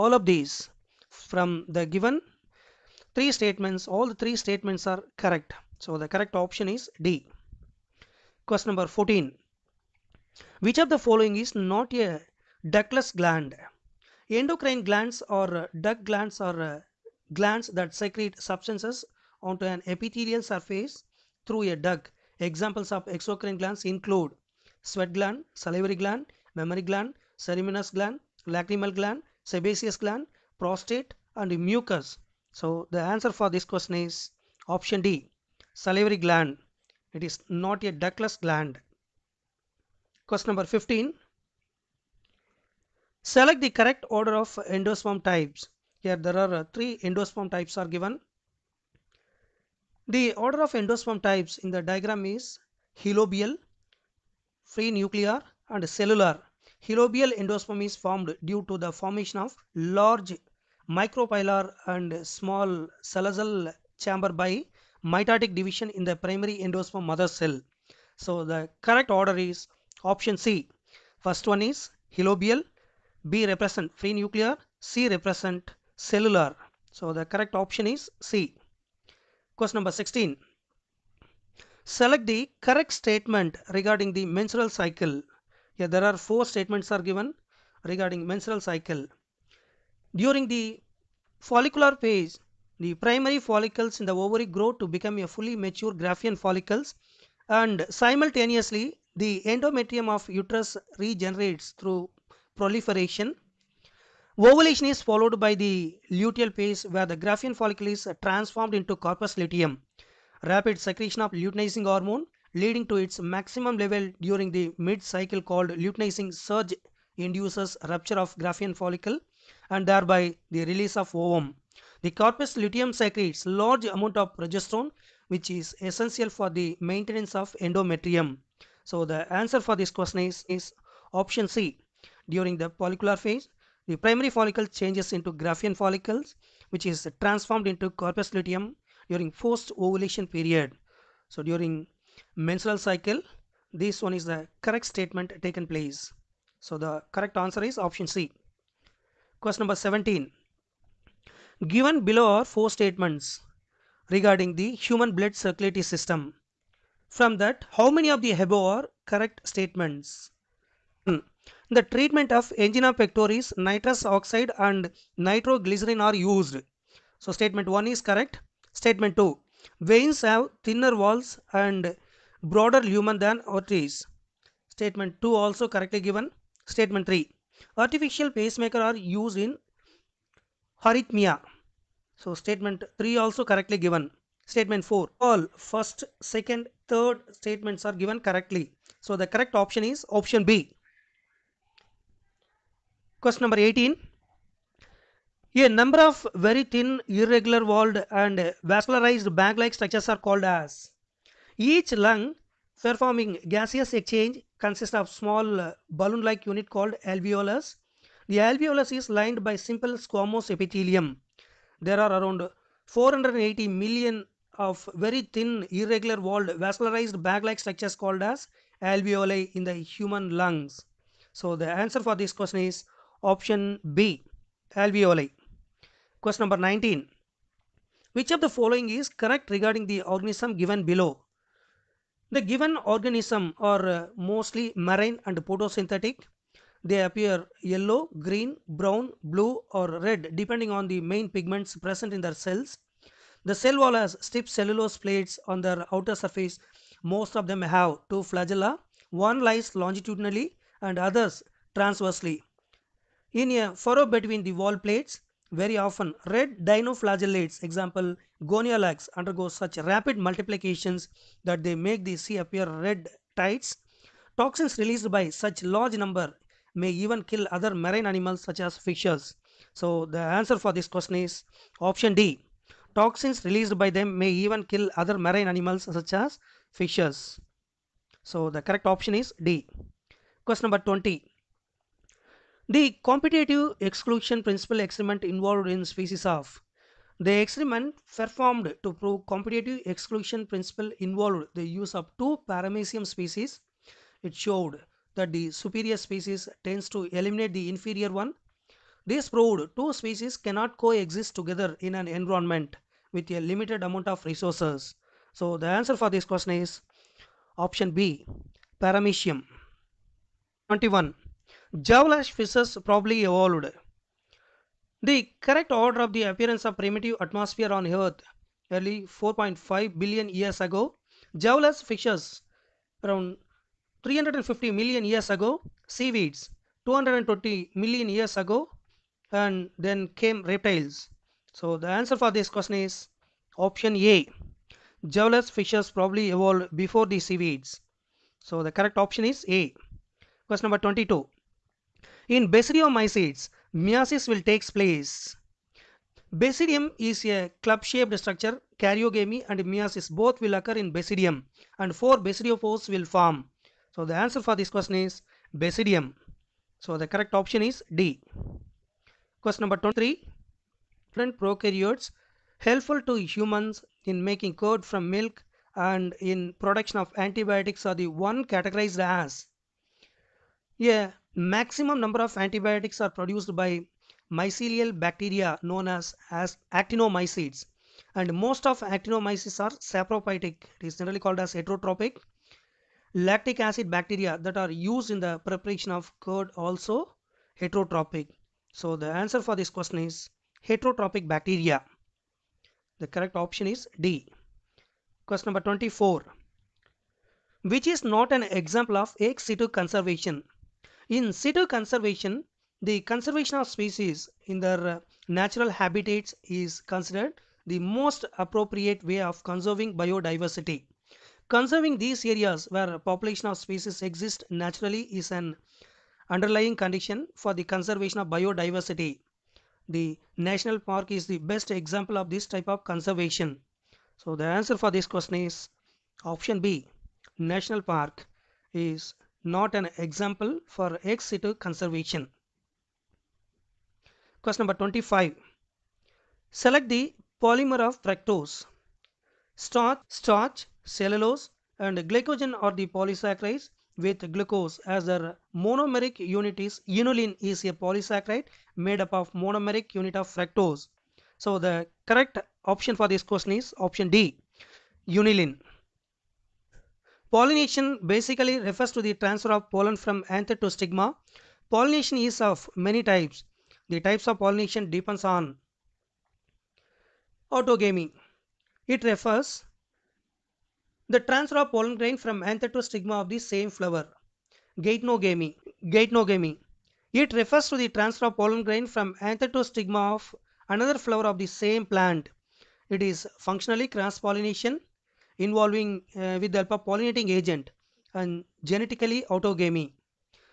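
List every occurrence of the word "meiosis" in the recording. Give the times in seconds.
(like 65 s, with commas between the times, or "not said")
343 s, 349 s.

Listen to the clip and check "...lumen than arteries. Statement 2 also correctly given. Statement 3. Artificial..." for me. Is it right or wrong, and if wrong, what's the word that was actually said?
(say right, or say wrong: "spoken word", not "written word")
right.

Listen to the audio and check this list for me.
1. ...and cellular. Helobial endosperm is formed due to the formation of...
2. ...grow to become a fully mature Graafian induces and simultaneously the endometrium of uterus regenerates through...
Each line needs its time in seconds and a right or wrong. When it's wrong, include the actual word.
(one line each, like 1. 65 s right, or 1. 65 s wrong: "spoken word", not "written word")
1. 55 s right
2. 94 s wrong: "follicles", not "induces".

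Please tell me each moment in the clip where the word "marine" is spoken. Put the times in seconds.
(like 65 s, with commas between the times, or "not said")
234 s, 267 s, 275 s.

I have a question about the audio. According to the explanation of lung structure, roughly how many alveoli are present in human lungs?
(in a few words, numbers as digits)
480 million.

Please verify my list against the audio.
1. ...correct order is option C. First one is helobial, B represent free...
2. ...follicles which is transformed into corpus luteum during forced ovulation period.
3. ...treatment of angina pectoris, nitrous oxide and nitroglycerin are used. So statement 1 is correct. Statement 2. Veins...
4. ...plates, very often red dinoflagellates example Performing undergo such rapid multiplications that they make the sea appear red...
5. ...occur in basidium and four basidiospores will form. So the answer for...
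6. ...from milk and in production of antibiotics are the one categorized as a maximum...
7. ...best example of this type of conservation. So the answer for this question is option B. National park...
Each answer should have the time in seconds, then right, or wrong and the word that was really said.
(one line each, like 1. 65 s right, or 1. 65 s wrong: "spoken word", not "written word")
1. 68 s right
2. 135 s right
3. 161 s right
4. 254 s wrong: "Gonyaulax", not "Performing"
5. 350 s right
6. 364 s right
7. 421 s right.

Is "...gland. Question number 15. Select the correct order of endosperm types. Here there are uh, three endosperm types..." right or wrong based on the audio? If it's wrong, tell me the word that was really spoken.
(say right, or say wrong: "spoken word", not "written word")
right.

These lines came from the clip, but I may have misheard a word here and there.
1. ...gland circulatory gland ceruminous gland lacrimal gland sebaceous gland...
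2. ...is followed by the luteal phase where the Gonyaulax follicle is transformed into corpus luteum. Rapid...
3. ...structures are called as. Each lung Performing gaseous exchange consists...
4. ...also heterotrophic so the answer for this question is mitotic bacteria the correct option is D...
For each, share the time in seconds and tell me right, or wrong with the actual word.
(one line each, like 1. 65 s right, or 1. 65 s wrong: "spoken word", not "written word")
1. 26 s wrong: "mammary", not "circulatory"
2. 104 s wrong: "Graafian", not "Gonyaulax"
3. 199 s right
4. 386 s wrong: "heterotrophic", not "mitotic".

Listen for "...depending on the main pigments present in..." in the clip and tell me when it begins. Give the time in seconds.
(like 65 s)
240 s.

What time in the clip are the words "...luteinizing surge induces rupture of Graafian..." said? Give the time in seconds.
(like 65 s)
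115 s.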